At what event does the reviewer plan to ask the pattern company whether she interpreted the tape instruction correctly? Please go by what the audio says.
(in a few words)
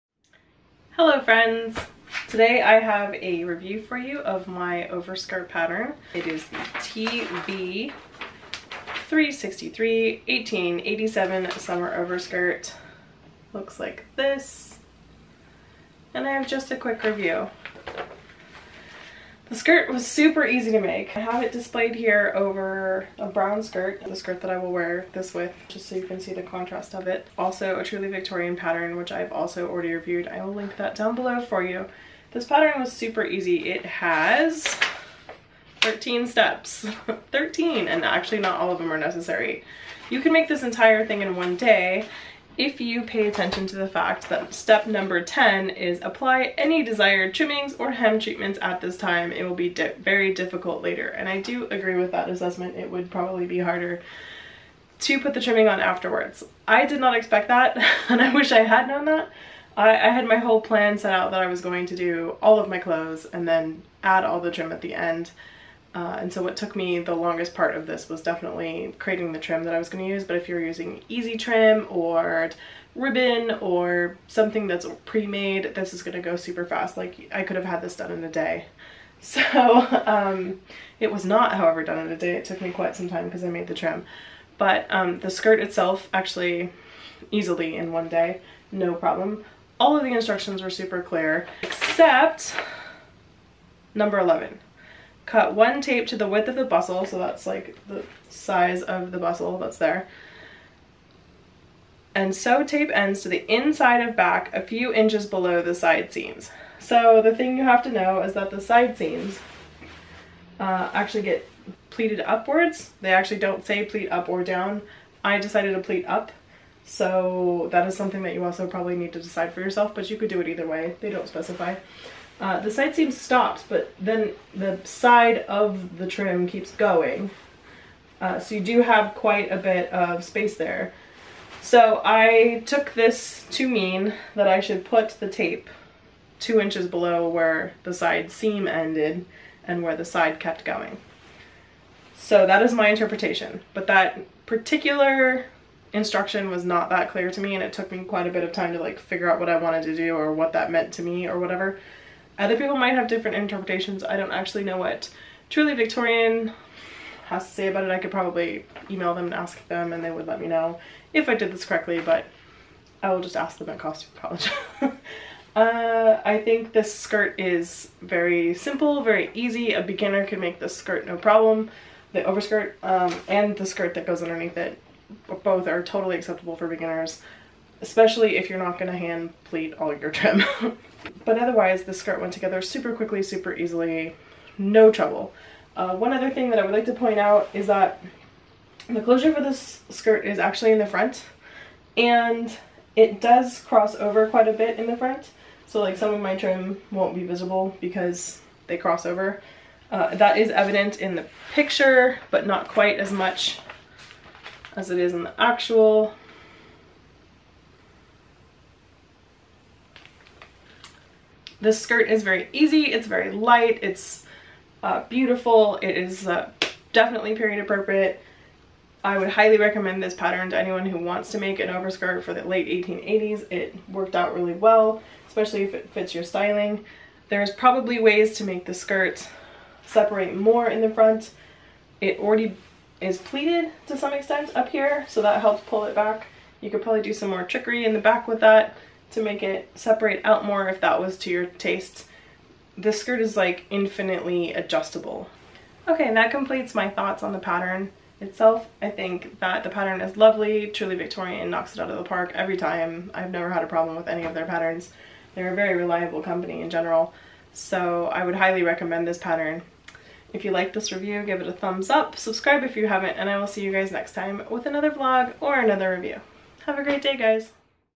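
Costume College.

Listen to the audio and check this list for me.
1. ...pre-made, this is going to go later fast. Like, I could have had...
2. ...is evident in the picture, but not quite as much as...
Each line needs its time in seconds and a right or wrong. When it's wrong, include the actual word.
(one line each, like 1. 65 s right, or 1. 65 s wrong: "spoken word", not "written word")
1. 75 s wrong: "super", not "later"
2. 200 s right.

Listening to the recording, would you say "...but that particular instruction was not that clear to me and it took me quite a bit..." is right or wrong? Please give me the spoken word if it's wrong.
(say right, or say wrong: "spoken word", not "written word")
right.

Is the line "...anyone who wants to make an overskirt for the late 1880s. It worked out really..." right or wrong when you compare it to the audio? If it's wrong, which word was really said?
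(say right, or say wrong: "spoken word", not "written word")
right.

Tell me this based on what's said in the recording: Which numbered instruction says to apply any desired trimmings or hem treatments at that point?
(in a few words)
10.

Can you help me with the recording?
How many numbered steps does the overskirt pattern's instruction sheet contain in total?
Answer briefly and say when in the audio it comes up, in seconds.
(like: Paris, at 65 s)
13, at 35 s.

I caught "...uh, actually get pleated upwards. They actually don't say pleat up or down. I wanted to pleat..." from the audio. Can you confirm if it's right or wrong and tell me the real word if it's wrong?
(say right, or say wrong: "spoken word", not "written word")
wrong: "decided", not "wanted".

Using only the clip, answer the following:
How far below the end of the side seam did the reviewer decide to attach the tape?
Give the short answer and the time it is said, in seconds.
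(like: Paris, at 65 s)
2 inches, at 136 s.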